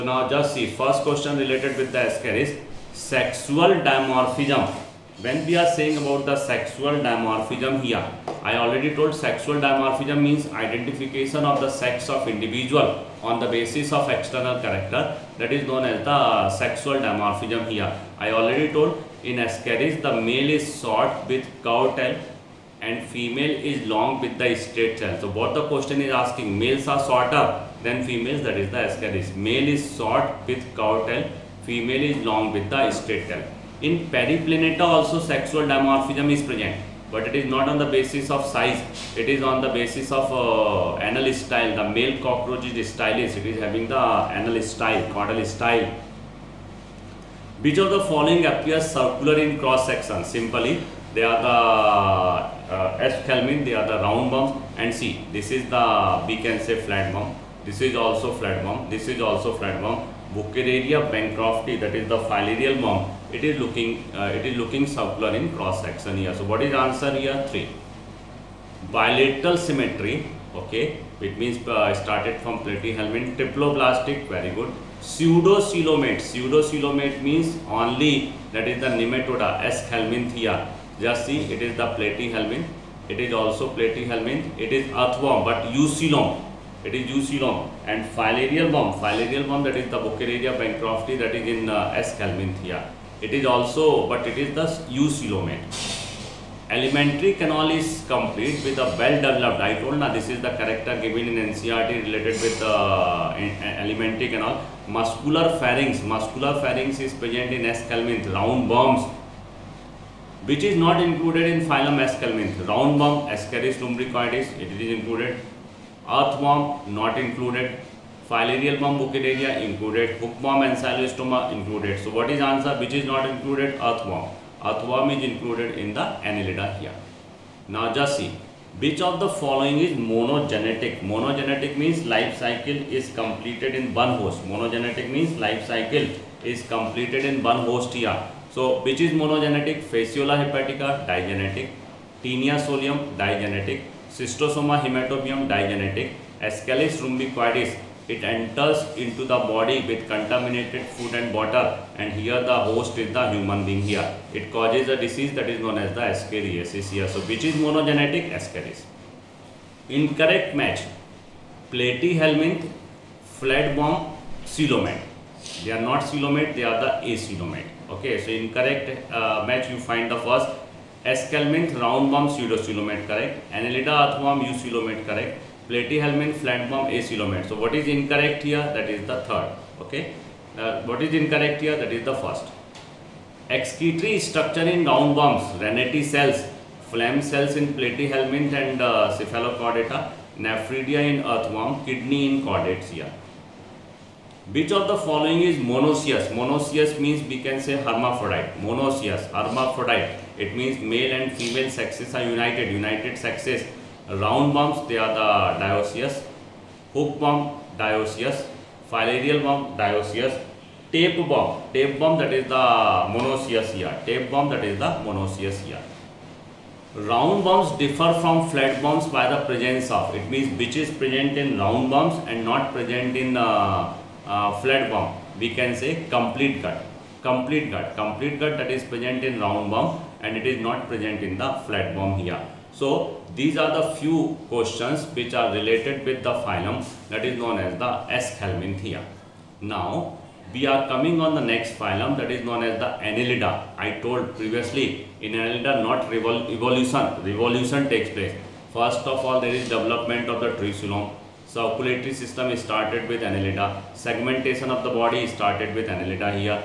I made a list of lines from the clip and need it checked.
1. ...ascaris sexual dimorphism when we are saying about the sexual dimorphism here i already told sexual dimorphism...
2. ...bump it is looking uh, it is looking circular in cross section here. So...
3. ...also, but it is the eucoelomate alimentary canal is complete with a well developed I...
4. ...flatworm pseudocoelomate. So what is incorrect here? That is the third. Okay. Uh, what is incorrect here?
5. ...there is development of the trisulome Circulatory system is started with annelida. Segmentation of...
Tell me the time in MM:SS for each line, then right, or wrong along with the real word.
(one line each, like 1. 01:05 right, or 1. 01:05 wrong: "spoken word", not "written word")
1. 00:02 right
2. 01:02 right
3. 01:33 right
4. 02:56 wrong: "acoelomate", not "pseudocoelomate"
5. 04:09 right.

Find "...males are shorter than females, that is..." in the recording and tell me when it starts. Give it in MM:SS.
00:26.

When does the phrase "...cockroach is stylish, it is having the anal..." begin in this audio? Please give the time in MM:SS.
00:42.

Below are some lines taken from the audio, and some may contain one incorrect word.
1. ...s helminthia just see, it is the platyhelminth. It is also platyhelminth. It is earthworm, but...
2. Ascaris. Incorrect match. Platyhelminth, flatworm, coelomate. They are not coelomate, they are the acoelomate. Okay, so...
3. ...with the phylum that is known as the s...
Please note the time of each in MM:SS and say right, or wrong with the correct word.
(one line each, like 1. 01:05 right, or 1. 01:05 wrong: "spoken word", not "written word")
1. 01:19 right
2. 02:38 right
3. 03:56 right.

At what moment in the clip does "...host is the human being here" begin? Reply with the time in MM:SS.
02:32.